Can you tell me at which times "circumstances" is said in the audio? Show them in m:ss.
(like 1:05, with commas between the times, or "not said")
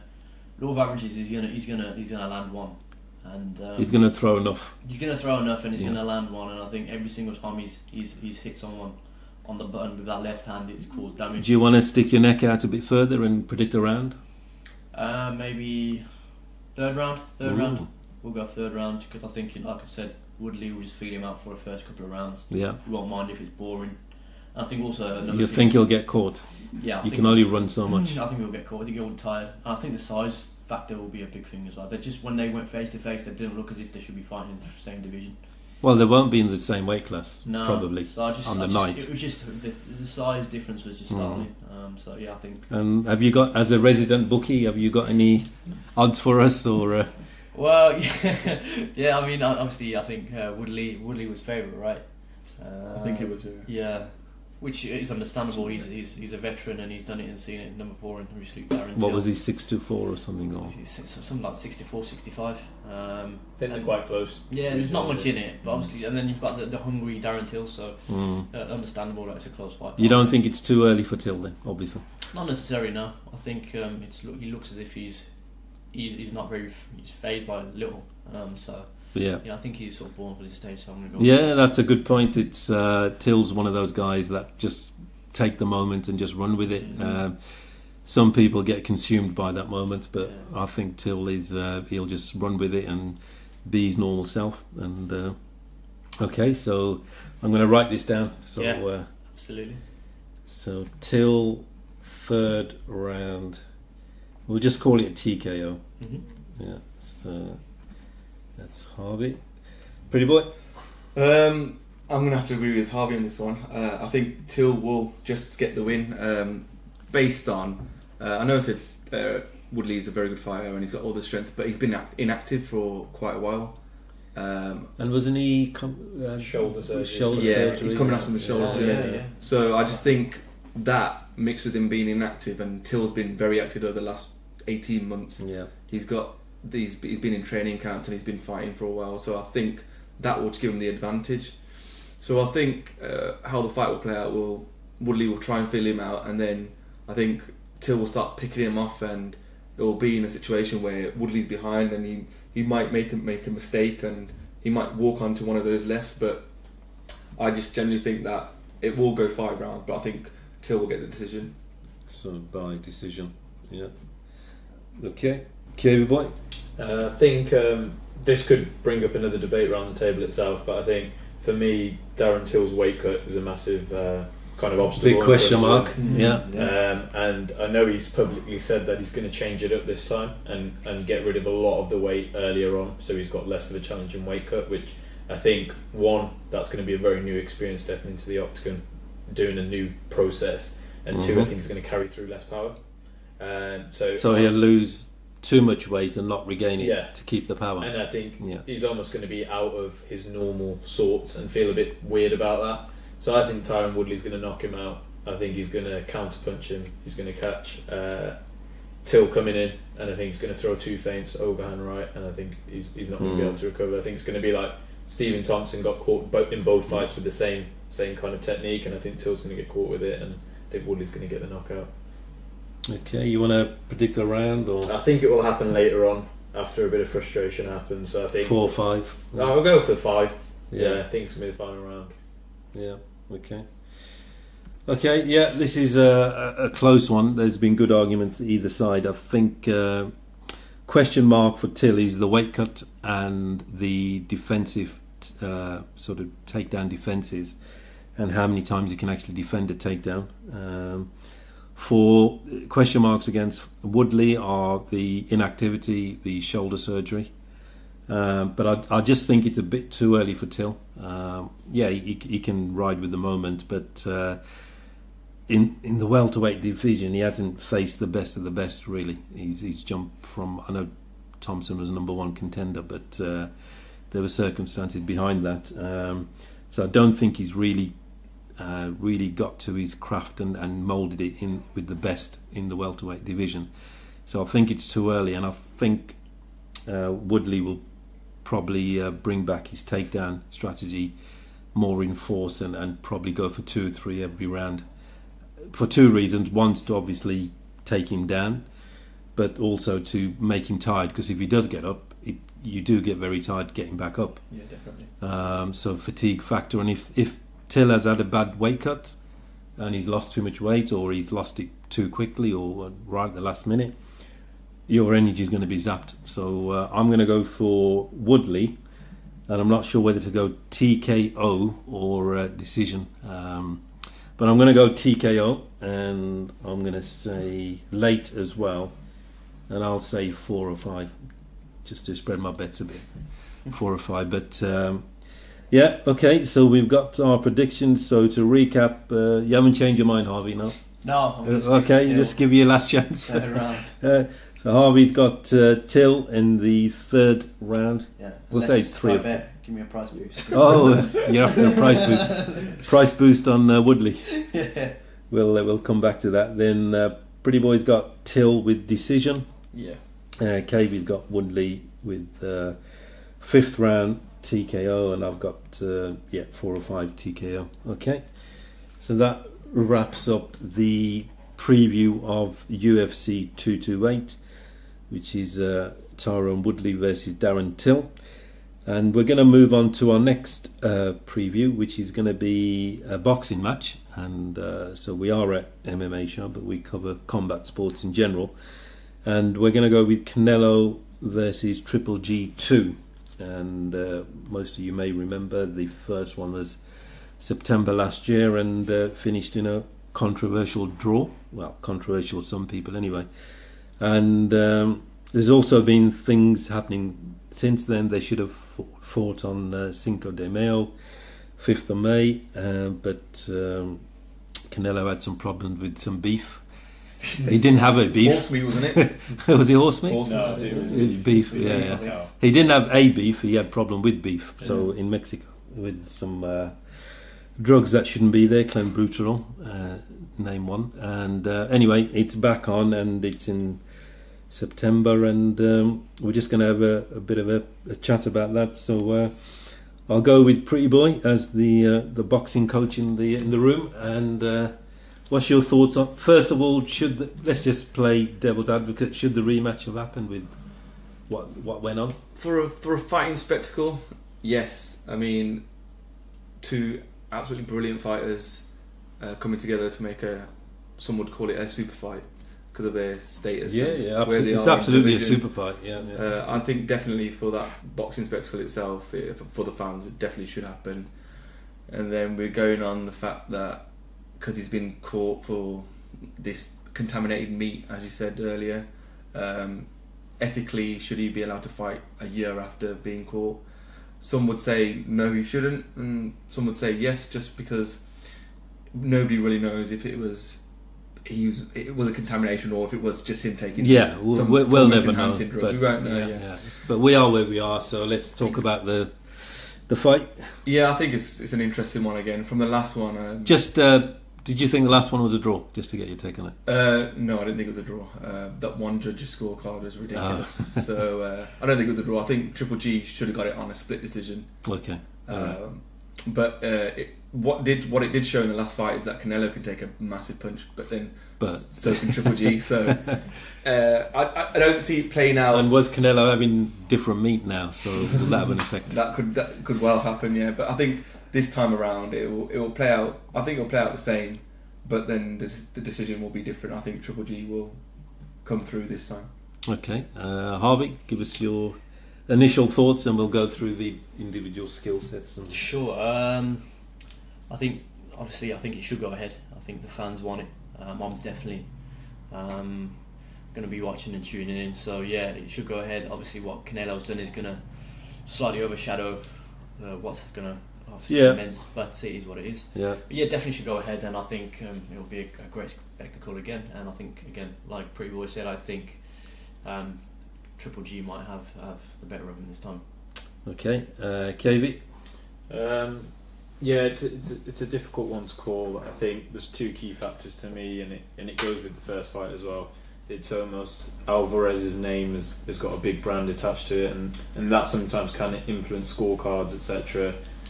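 4:34.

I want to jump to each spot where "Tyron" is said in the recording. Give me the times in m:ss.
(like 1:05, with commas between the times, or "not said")
3:23, 6:16.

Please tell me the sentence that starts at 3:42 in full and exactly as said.
Okay, you want to predict a round or?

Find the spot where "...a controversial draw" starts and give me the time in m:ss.
6:39.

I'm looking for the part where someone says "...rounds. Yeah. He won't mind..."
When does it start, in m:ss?
0:22.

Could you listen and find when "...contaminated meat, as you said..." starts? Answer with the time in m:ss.
7:56.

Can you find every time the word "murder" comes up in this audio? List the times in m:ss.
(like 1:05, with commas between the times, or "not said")
not said.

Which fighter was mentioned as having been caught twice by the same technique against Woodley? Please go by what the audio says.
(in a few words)
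Stephen Thompson.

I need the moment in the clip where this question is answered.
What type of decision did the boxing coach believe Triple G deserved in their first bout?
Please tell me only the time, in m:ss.
8:33.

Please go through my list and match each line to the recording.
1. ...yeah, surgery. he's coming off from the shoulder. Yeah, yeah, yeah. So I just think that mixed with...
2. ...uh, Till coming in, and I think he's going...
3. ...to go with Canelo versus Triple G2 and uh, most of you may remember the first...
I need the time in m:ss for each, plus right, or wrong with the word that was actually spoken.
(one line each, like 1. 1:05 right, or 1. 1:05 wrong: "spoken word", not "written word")
1. 2:07 right
2. 3:27 right
3. 6:29 right.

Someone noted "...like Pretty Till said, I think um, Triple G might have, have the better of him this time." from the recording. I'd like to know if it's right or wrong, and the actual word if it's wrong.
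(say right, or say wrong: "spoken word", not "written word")
wrong: "Boy", not "Till".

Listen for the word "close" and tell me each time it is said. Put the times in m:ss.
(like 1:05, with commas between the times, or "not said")
1:04, 1:09, 3:56.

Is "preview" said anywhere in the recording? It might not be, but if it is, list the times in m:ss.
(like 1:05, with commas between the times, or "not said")
6:11, 6:21.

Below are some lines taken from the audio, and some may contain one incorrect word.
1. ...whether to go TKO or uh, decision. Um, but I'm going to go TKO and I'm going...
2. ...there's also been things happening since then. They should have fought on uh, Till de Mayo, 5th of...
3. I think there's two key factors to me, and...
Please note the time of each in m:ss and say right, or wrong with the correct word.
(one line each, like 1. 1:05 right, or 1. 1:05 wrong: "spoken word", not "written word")
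1. 5:19 right
2. 6:45 wrong: "Cinco", not "Till"
3. 9:38 right.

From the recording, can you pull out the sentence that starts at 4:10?
Um, for question marks against Woodley are the inactivity, the shoulder surgery.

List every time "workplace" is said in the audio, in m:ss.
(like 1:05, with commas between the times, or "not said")
not said.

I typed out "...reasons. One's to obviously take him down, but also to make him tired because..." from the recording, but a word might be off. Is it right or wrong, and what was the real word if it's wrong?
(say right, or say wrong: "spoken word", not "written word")
right.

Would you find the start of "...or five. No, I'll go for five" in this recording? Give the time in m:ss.
3:48.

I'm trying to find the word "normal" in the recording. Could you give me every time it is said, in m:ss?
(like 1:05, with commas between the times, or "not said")
1:33, 3:20.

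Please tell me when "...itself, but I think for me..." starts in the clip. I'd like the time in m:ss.
2:50.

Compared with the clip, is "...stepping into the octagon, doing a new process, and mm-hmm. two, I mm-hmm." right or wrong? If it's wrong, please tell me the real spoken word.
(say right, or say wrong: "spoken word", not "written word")
right.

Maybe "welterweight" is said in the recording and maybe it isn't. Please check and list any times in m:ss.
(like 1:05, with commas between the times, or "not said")
4:26, 4:42.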